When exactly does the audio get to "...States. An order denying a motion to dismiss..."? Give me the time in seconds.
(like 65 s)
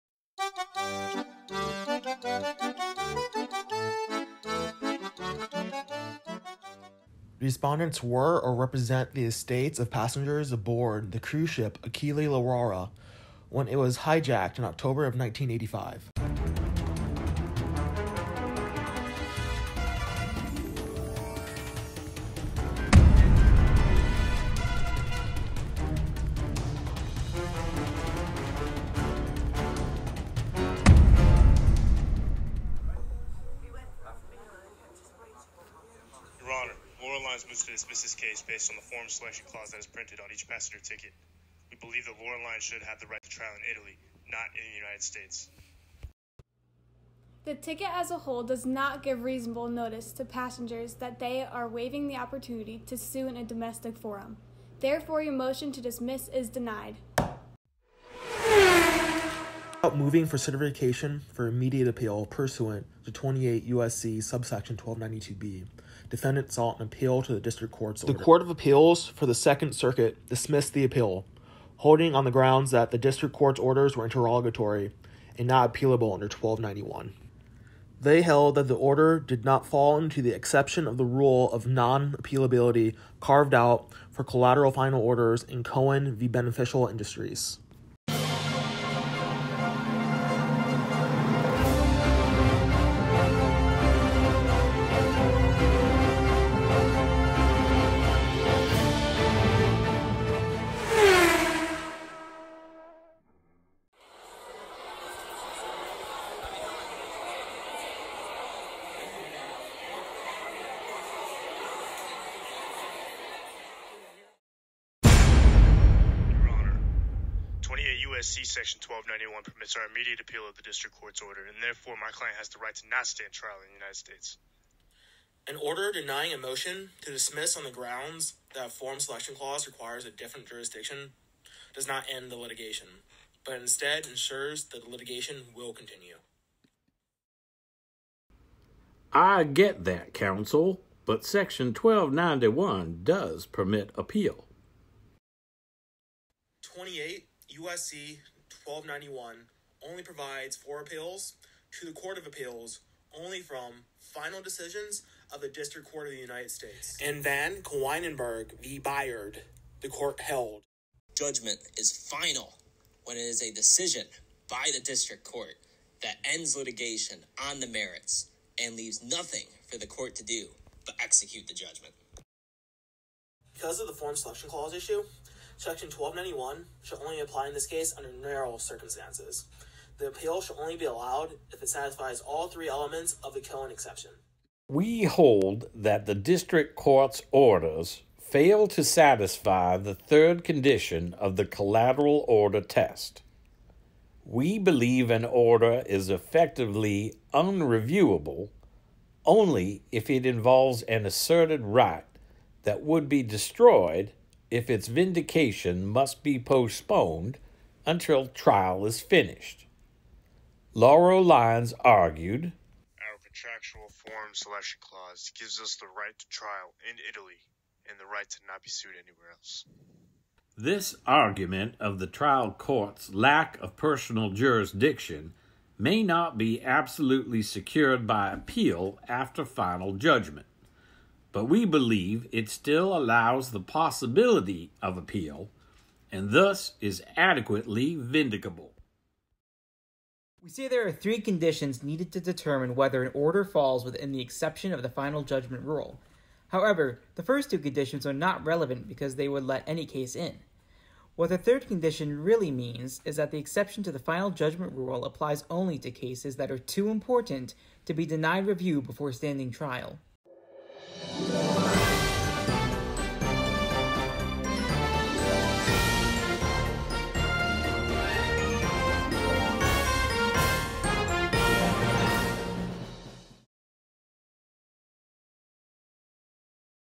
123 s.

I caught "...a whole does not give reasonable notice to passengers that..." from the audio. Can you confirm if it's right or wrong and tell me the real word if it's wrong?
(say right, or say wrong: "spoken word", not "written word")
right.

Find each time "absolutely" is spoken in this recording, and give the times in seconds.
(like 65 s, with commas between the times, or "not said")
226 s.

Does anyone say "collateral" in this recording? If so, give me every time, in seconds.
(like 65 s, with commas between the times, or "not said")
84 s, 191 s.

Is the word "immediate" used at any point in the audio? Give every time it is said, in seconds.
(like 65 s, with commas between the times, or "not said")
61 s, 119 s.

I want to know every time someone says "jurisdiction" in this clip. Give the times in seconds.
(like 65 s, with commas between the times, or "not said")
130 s, 224 s.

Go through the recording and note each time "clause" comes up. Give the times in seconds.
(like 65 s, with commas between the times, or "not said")
39 s, 129 s, 174 s, 214 s.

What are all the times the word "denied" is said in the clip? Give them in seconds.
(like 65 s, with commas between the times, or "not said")
56 s, 258 s.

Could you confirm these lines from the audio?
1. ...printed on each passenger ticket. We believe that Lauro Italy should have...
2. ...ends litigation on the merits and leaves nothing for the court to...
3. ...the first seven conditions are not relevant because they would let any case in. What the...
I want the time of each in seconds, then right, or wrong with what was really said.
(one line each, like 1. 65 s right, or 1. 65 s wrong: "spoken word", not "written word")
1. 39 s wrong: "Line", not "Italy"
2. 166 s right
3. 247 s wrong: "two", not "seven".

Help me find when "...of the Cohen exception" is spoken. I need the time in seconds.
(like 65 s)
183 s.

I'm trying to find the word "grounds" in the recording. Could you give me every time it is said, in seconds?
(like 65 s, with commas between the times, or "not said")
72 s, 127 s.